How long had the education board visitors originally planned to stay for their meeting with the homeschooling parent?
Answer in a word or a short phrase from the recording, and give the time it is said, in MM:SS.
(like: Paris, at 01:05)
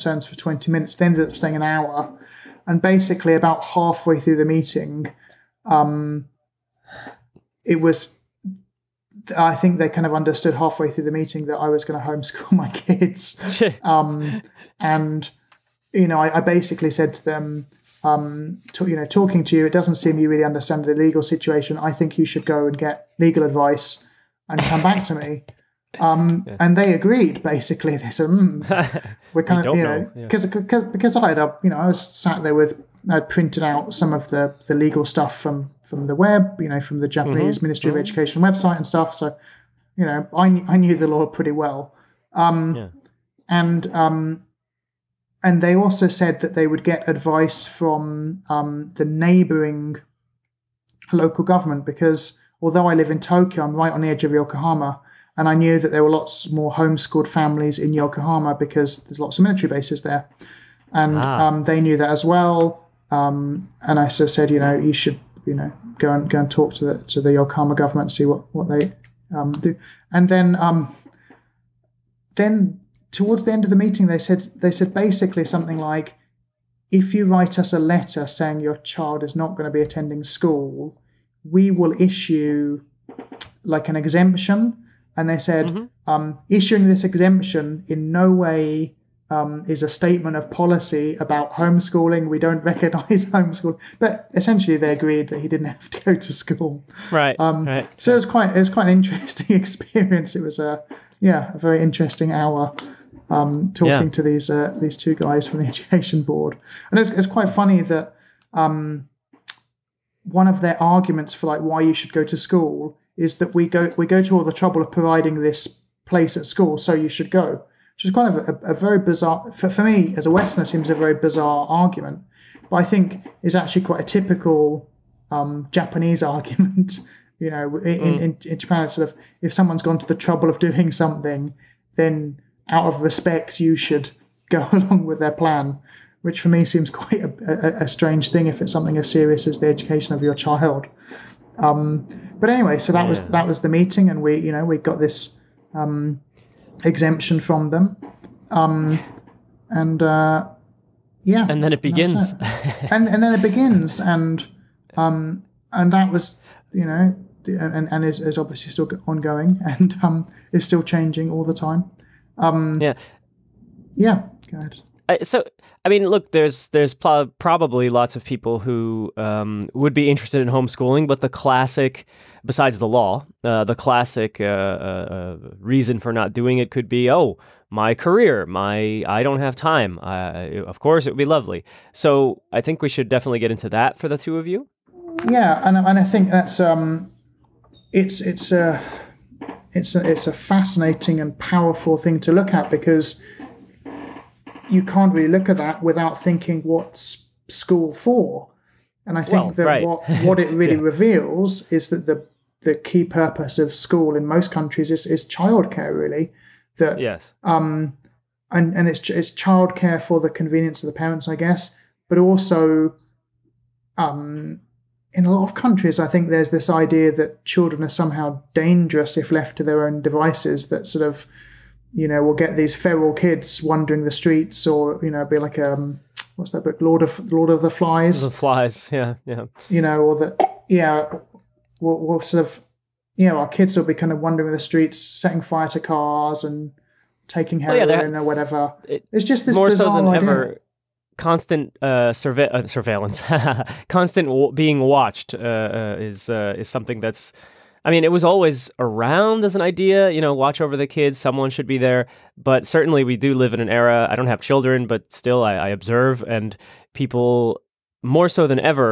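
20 minutes, at 00:00.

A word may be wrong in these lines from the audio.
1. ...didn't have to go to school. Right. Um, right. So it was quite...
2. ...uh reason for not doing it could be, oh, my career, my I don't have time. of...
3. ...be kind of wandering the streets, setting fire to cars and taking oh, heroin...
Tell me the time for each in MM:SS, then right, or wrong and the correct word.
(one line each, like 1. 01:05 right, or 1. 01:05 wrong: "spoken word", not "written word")
1. 01:35 right
2. 02:55 right
3. 03:53 right.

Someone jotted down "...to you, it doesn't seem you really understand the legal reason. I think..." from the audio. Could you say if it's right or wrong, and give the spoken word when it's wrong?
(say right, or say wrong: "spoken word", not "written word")
wrong: "situation", not "reason".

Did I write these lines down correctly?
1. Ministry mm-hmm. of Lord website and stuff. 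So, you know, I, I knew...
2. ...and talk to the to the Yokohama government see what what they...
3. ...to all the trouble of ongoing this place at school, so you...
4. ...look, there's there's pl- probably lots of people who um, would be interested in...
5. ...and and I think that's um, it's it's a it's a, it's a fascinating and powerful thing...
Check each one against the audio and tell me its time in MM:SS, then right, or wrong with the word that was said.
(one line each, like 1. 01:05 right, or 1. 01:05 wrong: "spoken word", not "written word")
1. 00:37 wrong: "Education", not "Lord"
2. 01:06 right
3. 01:54 wrong: "providing", not "ongoing"
4. 02:46 right
5. 03:05 right.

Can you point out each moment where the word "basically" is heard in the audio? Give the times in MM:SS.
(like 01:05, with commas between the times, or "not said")
00:02, 00:16, 00:27, 01:14.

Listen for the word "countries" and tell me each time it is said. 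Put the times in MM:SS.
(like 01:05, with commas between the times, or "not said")
03:24, 03:35.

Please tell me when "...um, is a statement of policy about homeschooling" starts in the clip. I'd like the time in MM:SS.
01:29.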